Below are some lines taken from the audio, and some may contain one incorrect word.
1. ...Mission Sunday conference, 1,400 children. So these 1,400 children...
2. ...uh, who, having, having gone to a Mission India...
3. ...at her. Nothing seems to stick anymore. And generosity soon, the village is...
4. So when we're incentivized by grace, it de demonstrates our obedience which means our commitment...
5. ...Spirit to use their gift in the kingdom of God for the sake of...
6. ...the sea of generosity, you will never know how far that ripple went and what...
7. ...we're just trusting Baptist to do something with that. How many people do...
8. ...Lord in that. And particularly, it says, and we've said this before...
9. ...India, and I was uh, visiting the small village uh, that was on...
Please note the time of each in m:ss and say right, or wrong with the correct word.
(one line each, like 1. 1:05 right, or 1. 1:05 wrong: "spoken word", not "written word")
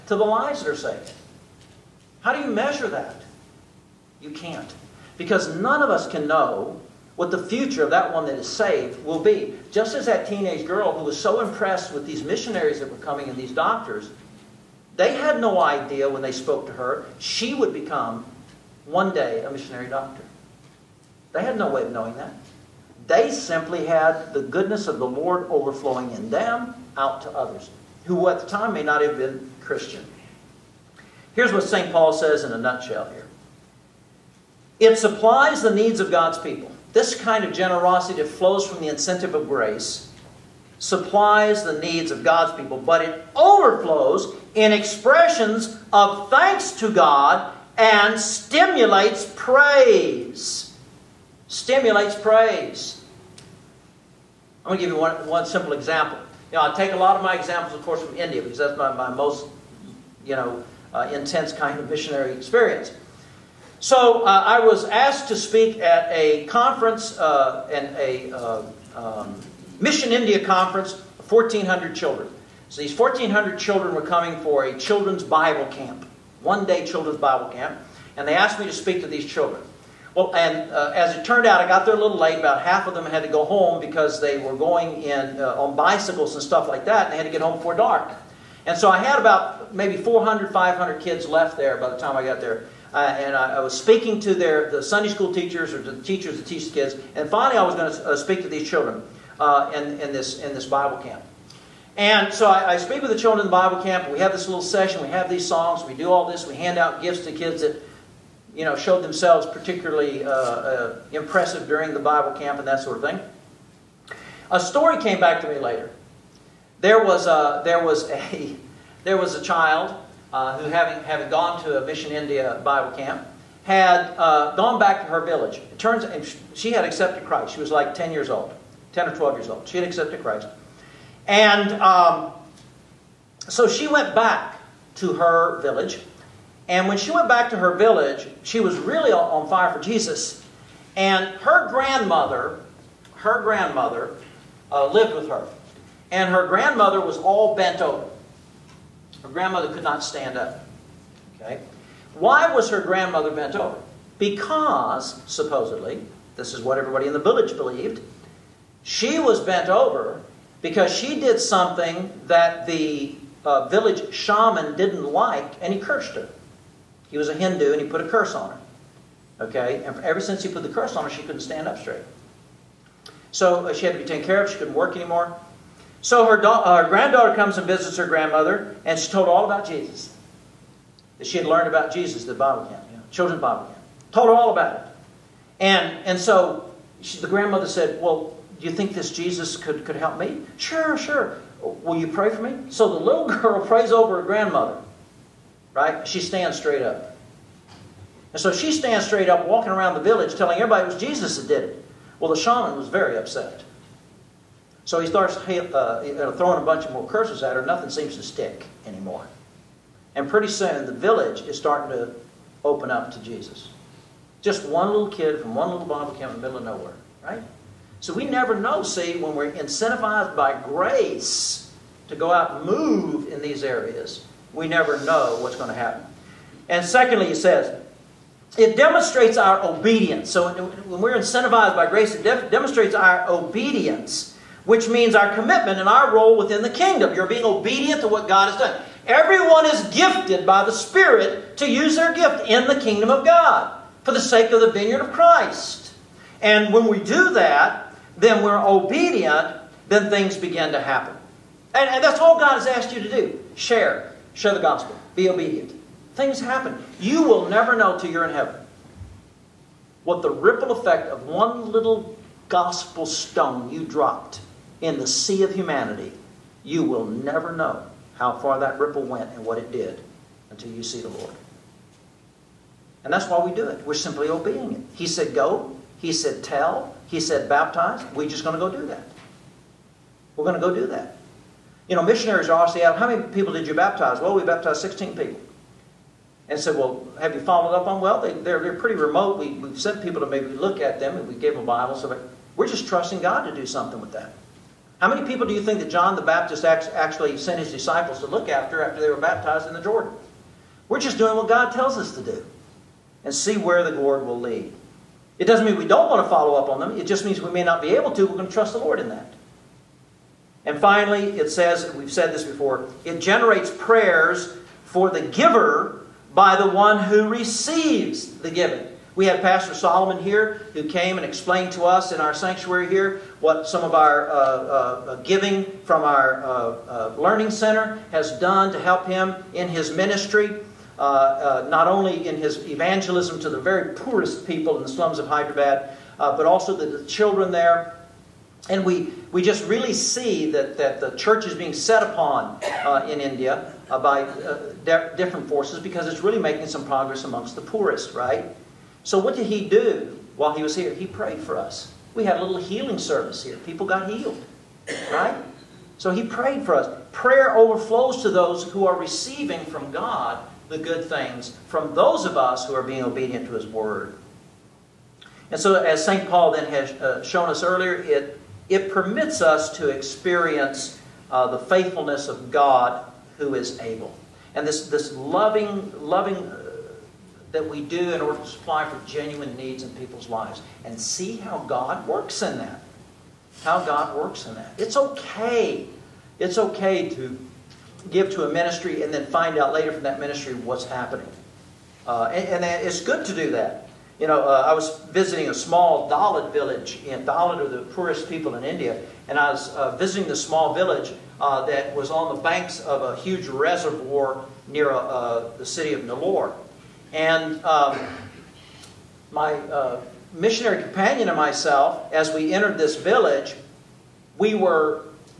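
1. 1:09 wrong: "India", not "Sunday"
2. 2:00 right
3. 3:27 wrong: "pretty", not "generosity"
4. 3:50 right
5. 4:00 right
6. 4:24 wrong: "humanity", not "generosity"
7. 4:52 wrong: "God", not "Baptist"
8. 5:08 wrong: "finally", not "particularly"
9. 6:38 right.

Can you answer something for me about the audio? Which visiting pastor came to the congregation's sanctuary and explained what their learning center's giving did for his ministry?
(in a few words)
Pastor Solomon.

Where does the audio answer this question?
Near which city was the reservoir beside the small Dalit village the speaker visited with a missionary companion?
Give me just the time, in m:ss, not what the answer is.
6:46.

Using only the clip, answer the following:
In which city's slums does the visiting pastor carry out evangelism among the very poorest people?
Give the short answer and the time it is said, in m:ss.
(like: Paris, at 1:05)
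Hyderabad, at 5:35.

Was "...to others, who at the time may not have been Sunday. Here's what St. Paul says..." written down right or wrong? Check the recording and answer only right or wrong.
wrong.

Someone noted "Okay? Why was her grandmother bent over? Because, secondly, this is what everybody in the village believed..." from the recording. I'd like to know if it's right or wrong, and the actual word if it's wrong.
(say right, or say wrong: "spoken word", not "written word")
wrong: "supposedly", not "secondly".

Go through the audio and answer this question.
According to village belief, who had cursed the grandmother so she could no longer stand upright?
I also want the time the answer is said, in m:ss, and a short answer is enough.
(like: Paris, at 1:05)
village shaman, at 2:43.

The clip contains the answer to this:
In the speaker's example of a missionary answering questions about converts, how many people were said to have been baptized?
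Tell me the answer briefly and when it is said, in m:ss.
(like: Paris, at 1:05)
16, at 4:44.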